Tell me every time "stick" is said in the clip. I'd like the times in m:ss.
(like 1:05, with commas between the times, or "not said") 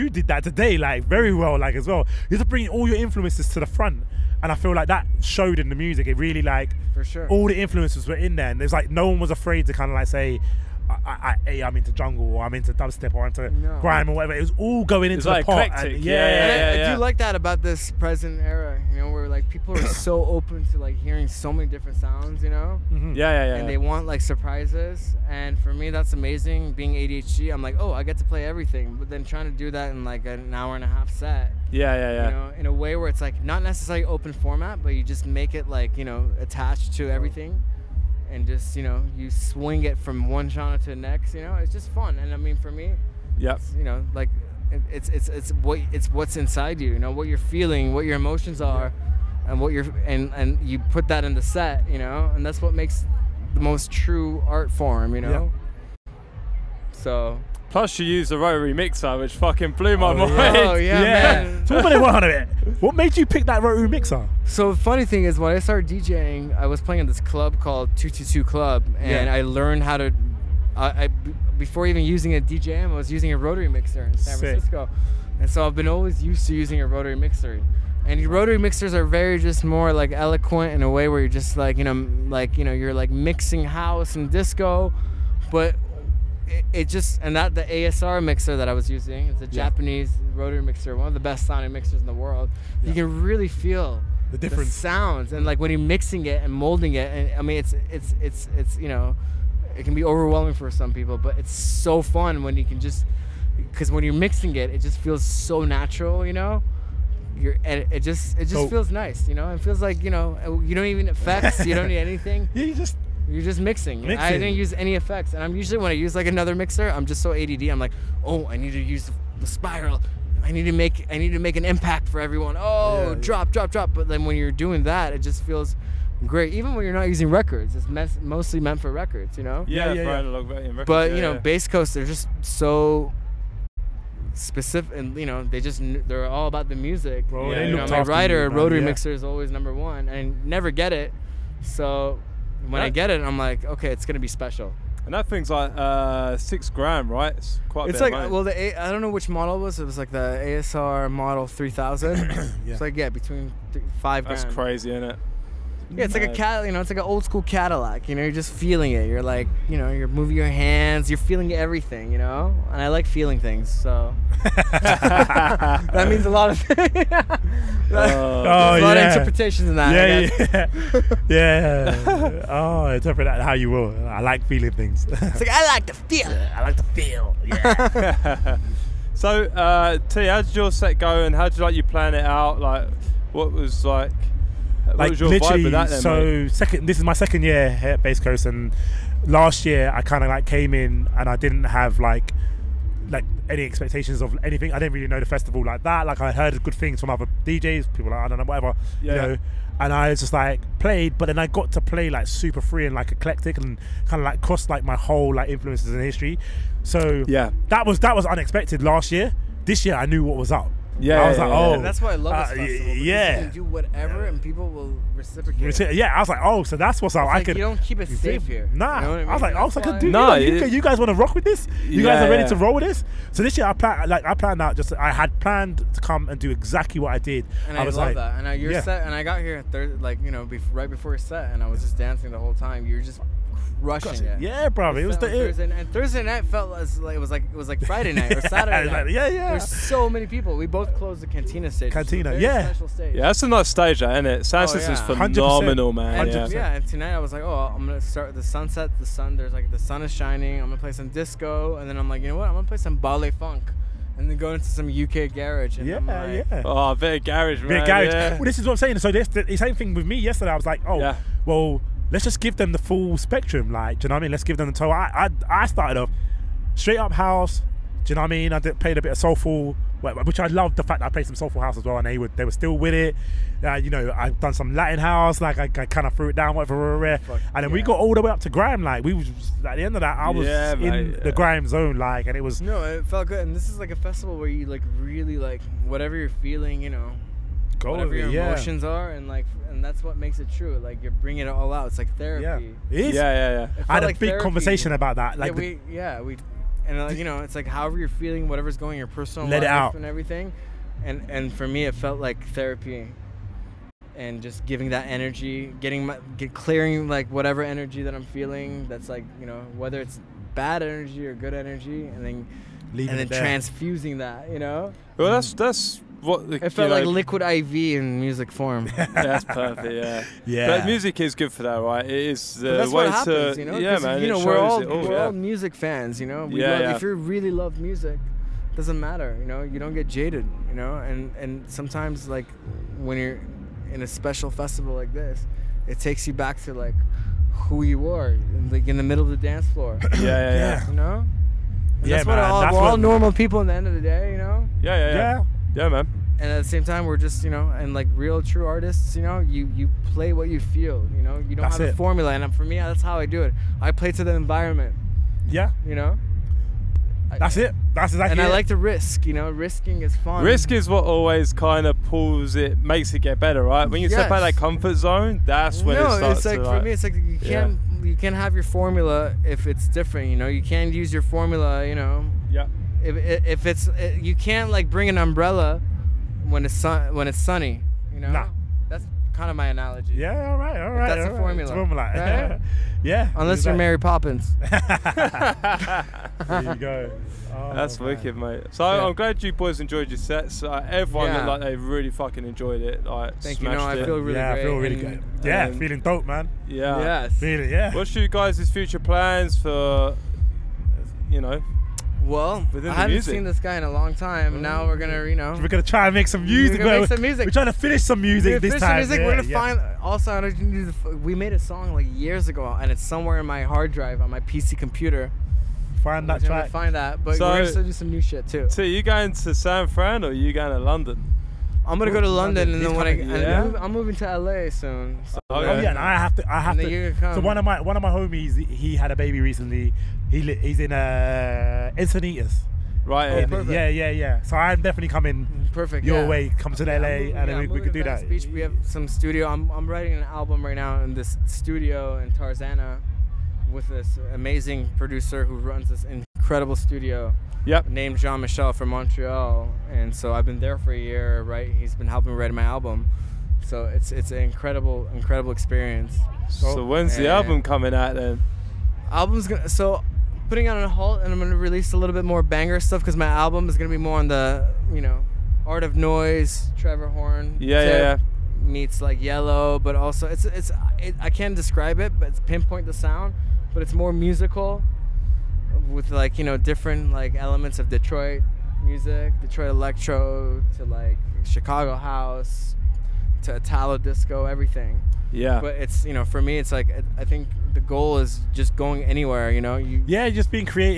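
not said.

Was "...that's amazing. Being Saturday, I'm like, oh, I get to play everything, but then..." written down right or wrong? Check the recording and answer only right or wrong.
wrong.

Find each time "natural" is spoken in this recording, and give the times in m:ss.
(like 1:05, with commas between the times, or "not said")
1:45.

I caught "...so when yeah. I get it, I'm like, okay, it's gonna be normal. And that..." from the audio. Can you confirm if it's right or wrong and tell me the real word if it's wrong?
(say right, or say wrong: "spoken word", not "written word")
wrong: "special", not "normal".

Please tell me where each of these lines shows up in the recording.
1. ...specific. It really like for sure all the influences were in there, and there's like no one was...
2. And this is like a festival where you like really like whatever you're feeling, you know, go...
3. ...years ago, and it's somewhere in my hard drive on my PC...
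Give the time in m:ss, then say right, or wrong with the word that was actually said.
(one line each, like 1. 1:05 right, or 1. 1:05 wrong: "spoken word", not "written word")
1. 0:05 wrong: "music", not "specific"
2. 4:43 right
3. 6:52 right.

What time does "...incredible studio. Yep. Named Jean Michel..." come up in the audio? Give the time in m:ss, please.
7:26.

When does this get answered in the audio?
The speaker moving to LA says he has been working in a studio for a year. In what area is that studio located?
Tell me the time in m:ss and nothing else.
7:22.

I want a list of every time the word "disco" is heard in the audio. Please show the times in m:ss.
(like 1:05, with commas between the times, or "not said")
1:24, 4:11, 8:03.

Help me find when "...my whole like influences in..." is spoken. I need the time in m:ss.
3:24.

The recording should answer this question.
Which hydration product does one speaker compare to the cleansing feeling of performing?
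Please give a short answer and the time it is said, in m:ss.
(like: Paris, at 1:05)
Liquid IV, at 5:17.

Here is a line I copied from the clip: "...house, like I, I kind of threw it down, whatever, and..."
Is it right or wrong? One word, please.
right.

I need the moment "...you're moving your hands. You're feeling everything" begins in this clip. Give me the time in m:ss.
2:39.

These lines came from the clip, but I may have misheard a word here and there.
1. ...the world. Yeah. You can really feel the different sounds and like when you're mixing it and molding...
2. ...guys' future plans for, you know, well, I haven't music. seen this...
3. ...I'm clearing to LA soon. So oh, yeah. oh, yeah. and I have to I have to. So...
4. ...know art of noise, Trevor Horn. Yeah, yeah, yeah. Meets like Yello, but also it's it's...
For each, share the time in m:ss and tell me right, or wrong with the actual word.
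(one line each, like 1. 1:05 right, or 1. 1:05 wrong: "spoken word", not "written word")
1. 1:32 right
2. 6:38 right
3. 7:03 wrong: "moving", not "clearing"
4. 7:45 right.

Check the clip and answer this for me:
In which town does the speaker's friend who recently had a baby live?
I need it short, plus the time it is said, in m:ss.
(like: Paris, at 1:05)
Encinitas, at 7:11.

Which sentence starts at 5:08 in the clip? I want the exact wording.
That's like you know whether it's bad energy or good energy, and then.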